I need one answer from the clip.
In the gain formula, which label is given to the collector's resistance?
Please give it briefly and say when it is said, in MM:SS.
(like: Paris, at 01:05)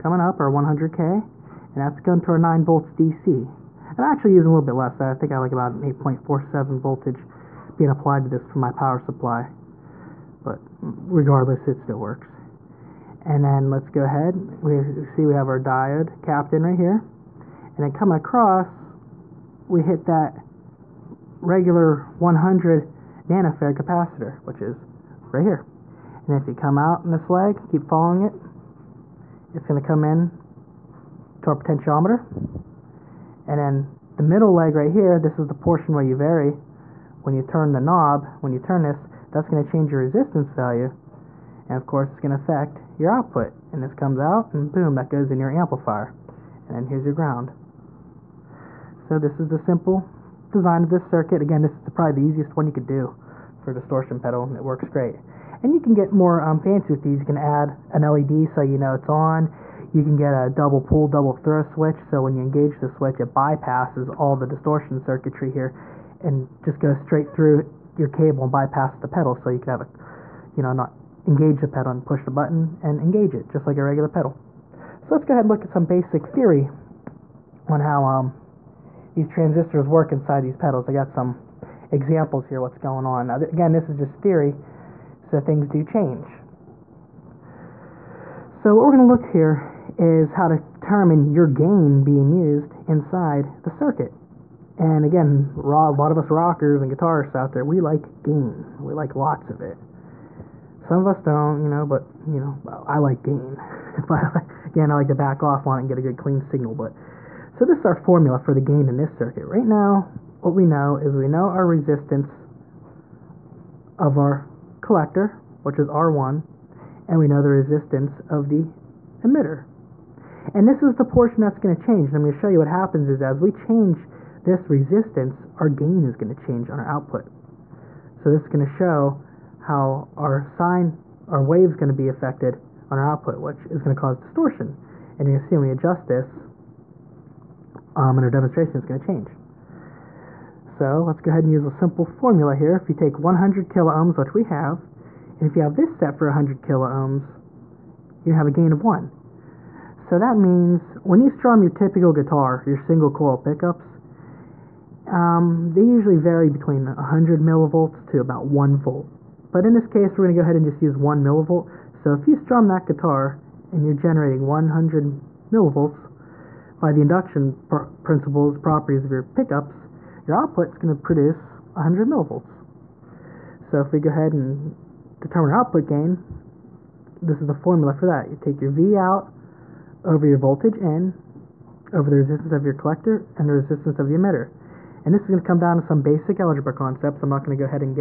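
R1, at 01:55.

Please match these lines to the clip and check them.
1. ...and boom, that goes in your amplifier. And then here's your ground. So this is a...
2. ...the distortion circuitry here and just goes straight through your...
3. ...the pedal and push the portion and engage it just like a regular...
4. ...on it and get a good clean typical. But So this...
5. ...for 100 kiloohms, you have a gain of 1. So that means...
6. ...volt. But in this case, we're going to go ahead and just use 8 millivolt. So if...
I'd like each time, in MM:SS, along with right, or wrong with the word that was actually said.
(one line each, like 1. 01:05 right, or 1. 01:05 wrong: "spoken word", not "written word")
1. 00:44 right
2. 01:04 right
3. 01:11 wrong: "button", not "portion"
4. 01:45 wrong: "signal", not "typical"
5. 02:26 right
6. 02:38 wrong: "1", not "8".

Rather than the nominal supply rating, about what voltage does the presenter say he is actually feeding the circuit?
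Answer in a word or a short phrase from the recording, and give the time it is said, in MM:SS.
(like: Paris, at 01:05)
8.47 volts, at 00:05.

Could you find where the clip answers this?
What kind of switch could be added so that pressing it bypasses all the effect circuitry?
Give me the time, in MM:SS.
01:00.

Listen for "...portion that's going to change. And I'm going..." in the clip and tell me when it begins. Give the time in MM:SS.
02:01.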